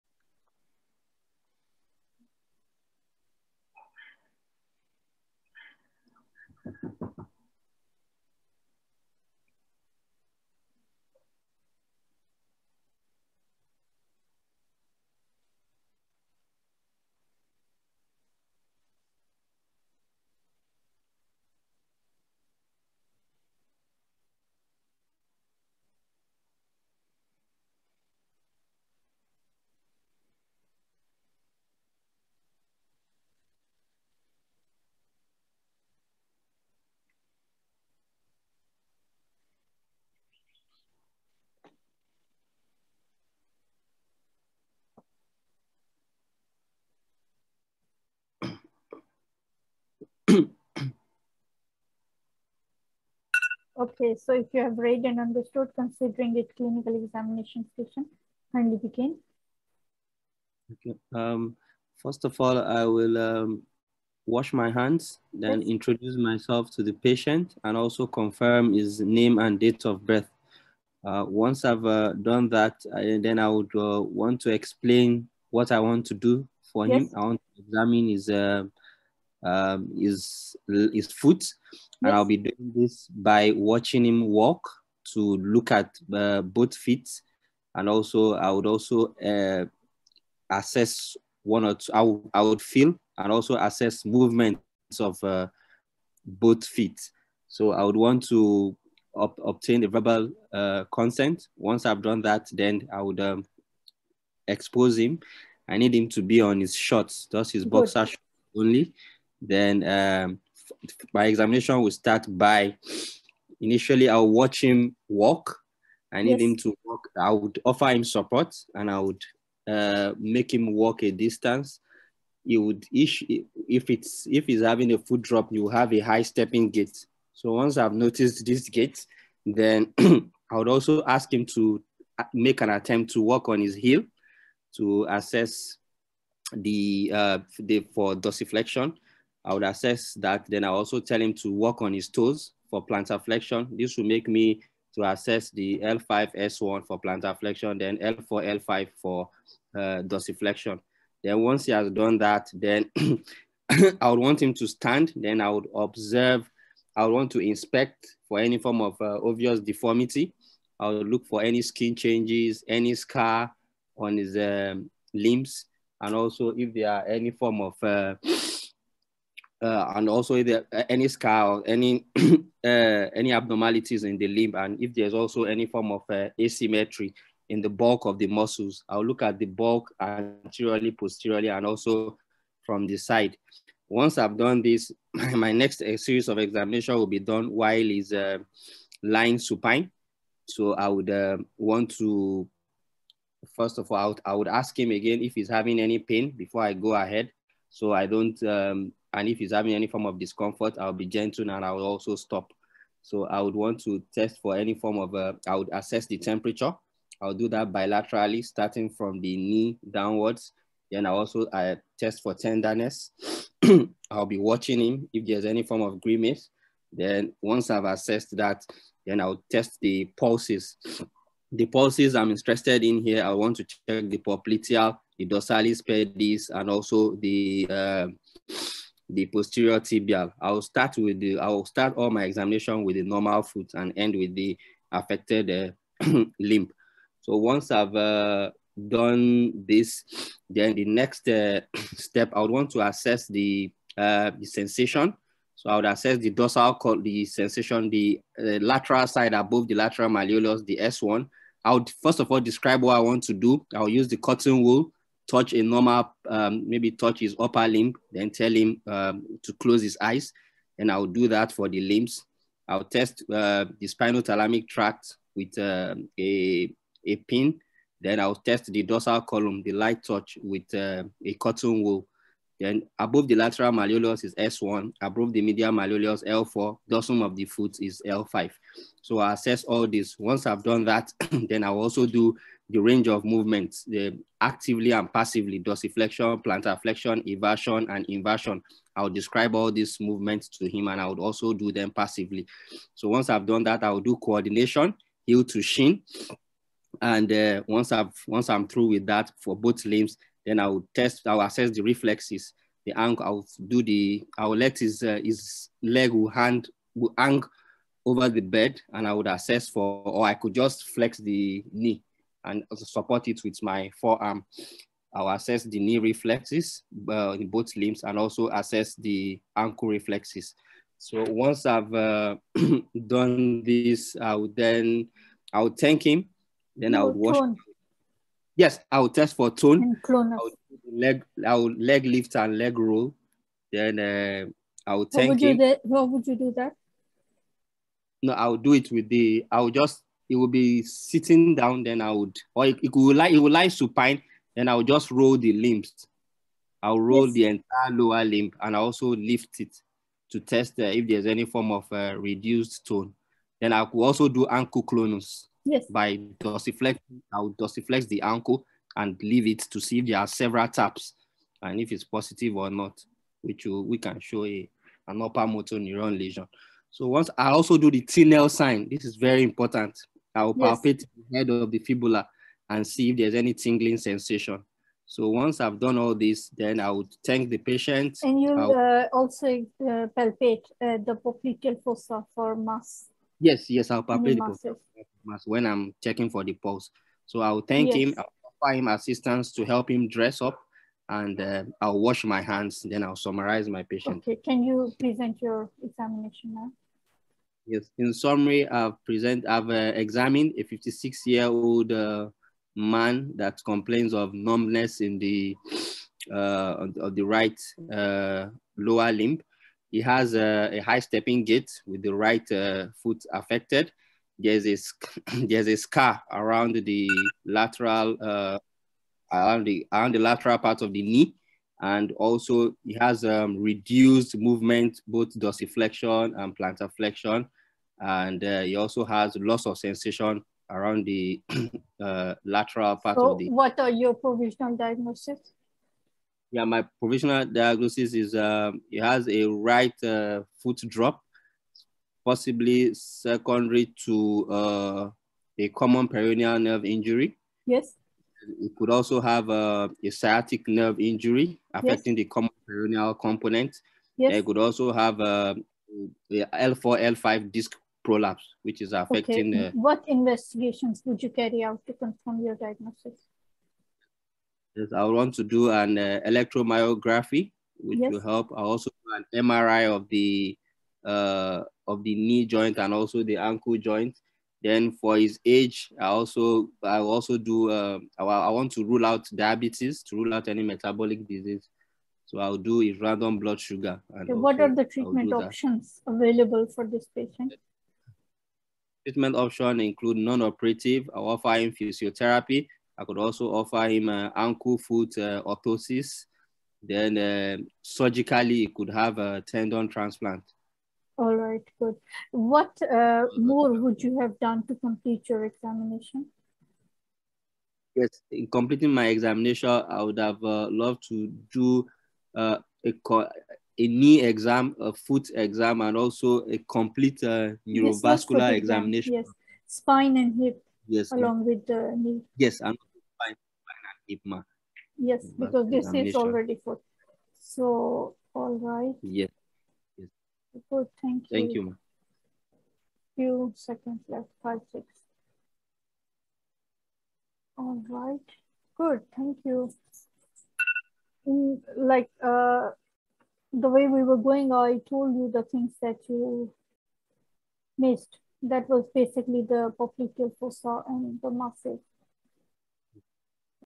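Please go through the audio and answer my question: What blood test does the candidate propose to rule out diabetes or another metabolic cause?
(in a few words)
Random blood sugar.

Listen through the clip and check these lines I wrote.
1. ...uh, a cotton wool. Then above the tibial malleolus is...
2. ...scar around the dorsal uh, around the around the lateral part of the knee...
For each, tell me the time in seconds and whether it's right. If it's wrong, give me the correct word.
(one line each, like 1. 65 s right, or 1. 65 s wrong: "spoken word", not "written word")
1. 270 s wrong: "lateral", not "tibial"
2. 415 s wrong: "lateral", not "dorsal".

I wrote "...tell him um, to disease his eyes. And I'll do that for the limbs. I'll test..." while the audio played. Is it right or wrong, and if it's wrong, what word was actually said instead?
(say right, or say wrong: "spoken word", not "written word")
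wrong: "close", not "disease".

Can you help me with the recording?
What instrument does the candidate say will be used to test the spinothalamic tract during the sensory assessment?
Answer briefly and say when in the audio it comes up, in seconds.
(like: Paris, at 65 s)
a pin, at 267 s.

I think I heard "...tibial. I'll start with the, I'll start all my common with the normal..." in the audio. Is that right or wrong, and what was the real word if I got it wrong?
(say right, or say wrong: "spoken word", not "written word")
wrong: "examination", not "common".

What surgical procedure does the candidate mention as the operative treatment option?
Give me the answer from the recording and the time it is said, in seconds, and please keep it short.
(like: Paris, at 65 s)
Tendon transplant, at 499 s.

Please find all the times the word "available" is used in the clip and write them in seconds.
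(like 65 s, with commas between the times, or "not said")
486 s.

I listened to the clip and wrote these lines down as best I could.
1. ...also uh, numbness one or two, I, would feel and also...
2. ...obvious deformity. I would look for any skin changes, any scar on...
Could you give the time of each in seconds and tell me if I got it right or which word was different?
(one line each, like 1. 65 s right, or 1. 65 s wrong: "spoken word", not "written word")
1. 88 s wrong: "assess", not "numbness"
2. 159 s right.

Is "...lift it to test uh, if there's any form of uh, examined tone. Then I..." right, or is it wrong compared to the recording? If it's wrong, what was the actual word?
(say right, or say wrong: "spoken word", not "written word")
wrong: "reduced", not "examined".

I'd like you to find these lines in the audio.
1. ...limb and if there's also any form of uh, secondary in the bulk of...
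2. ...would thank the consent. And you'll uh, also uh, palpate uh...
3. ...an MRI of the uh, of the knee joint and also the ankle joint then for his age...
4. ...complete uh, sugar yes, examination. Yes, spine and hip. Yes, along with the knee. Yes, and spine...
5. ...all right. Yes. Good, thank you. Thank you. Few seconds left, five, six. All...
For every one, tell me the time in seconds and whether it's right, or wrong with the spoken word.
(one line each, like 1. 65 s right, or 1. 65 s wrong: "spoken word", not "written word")
1. 174 s wrong: "asymmetry", not "secondary"
2. 376 s wrong: "patient", not "consent"
3. 469 s right
4. 516 s wrong: "neurovascular", not "sugar"
5. 528 s right.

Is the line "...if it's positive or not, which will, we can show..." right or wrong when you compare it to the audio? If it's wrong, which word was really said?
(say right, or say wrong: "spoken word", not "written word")
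right.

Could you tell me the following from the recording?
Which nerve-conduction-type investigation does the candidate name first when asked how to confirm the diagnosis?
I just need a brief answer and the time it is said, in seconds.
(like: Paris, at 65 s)
Electromyography, at 466 s.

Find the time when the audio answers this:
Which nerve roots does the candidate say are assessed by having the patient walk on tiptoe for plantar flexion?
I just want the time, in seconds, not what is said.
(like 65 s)
145 s.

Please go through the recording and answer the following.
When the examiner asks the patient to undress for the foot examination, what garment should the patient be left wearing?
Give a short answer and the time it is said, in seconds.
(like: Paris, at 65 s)
boxer shorts, at 107 s.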